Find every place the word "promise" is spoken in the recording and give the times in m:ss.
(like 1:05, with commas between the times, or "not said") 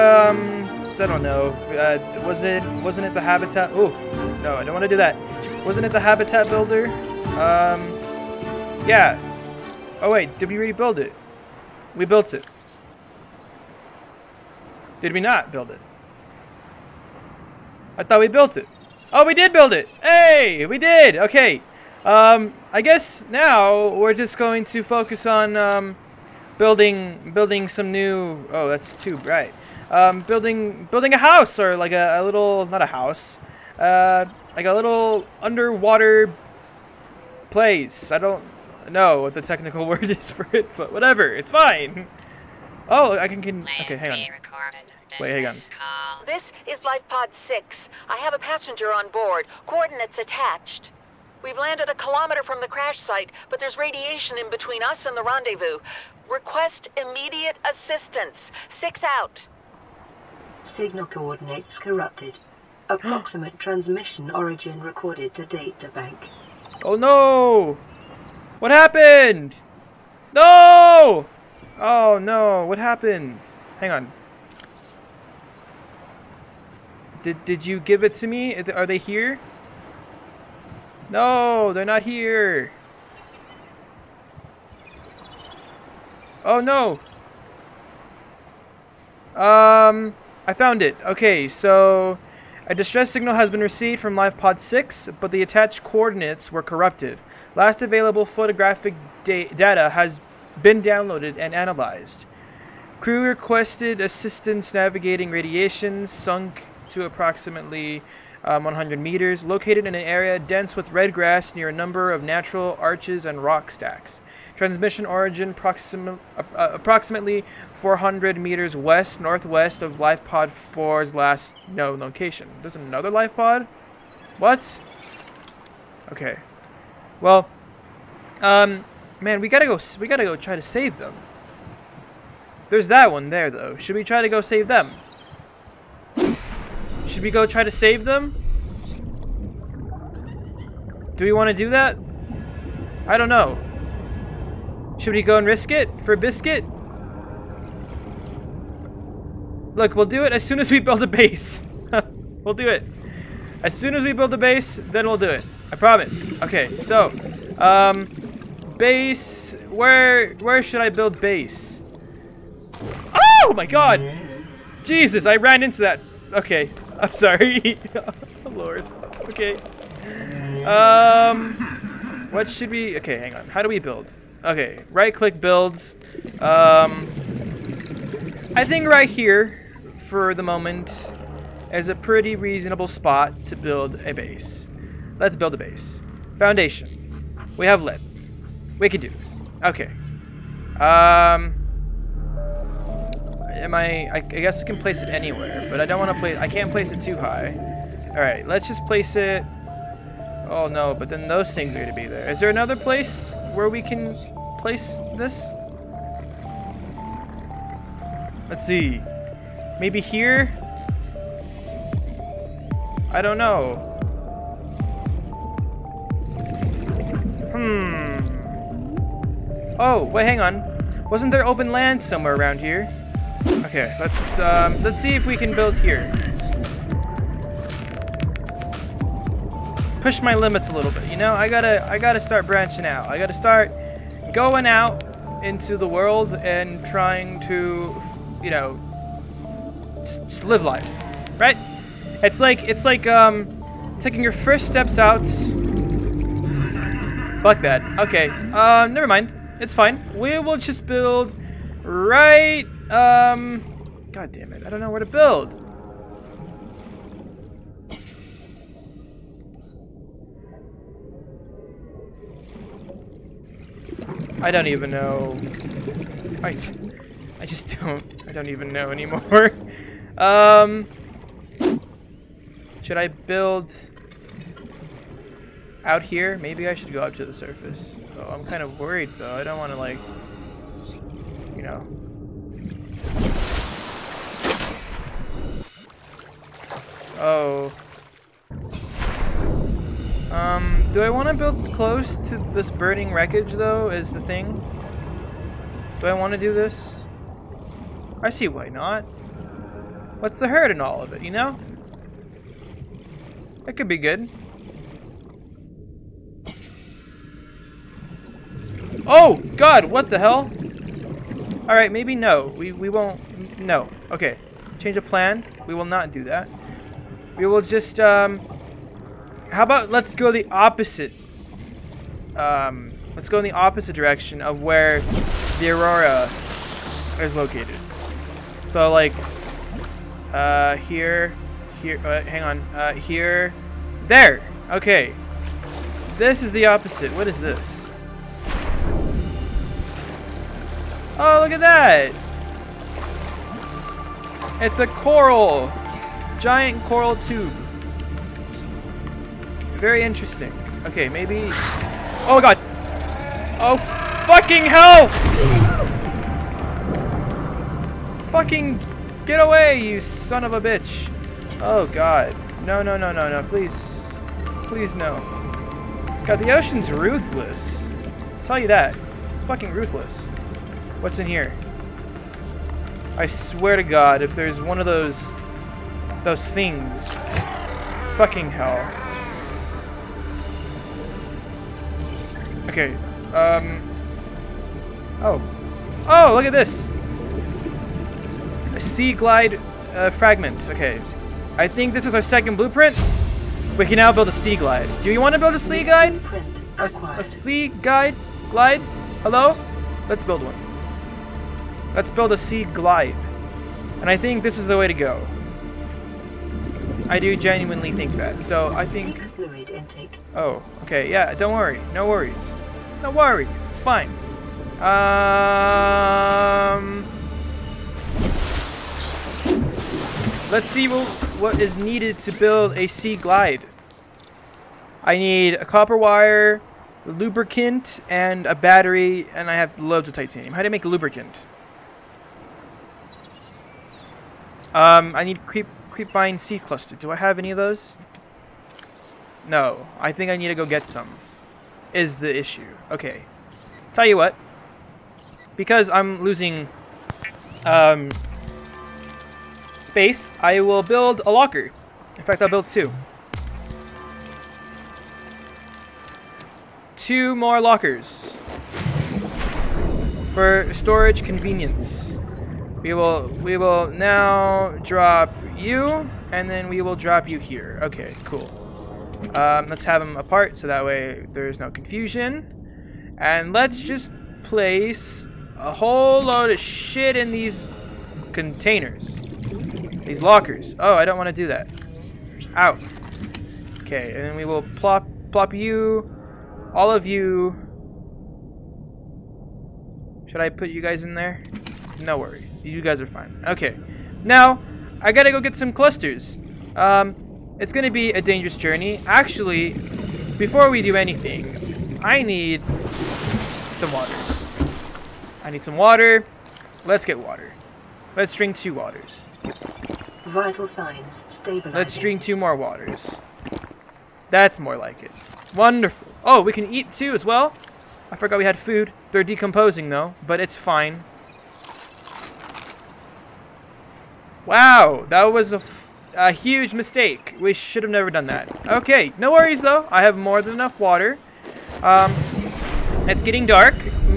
2:35.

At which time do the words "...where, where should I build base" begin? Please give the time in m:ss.
2:39.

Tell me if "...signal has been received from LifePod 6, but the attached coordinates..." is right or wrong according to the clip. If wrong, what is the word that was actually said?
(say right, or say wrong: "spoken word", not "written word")
right.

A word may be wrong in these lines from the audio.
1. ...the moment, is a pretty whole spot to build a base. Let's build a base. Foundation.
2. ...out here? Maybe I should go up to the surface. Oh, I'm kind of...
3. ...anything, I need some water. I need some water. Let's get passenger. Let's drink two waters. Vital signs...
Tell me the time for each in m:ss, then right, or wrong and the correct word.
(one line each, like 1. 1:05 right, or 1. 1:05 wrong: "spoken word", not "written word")
1. 3:00 wrong: "reasonable", not "whole"
2. 4:35 right
3. 8:20 wrong: "water", not "passenger".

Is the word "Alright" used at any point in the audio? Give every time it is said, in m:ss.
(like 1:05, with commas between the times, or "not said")
3:18, 5:11.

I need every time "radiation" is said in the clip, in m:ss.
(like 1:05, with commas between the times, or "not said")
0:53, 1:45.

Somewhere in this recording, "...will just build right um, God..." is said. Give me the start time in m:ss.
4:10.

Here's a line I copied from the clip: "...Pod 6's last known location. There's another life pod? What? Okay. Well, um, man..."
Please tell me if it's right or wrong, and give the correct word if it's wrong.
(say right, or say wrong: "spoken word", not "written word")
wrong: "4", not "6".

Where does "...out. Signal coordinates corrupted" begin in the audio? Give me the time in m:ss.
0:59.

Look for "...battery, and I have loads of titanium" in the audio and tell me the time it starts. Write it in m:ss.
7:08.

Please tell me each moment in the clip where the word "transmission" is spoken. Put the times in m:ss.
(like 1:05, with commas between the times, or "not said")
1:03, 1:54.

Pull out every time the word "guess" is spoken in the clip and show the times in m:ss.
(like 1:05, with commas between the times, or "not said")
0:22, 3:14.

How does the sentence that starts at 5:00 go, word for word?
What's the hurt in all of it, you know?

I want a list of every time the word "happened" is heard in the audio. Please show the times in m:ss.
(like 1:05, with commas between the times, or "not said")
1:08, 1:12.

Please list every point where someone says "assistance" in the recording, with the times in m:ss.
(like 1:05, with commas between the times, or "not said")
0:57, 1:43.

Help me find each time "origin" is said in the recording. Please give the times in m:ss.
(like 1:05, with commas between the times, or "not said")
1:04, 1:55.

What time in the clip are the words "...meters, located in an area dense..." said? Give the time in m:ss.
1:48.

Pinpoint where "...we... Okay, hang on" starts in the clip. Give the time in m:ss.
2:52.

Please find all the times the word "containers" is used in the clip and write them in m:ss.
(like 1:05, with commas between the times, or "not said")
7:58.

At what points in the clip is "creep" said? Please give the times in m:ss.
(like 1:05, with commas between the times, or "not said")
7:15.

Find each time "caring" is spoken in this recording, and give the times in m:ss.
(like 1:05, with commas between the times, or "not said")
not said.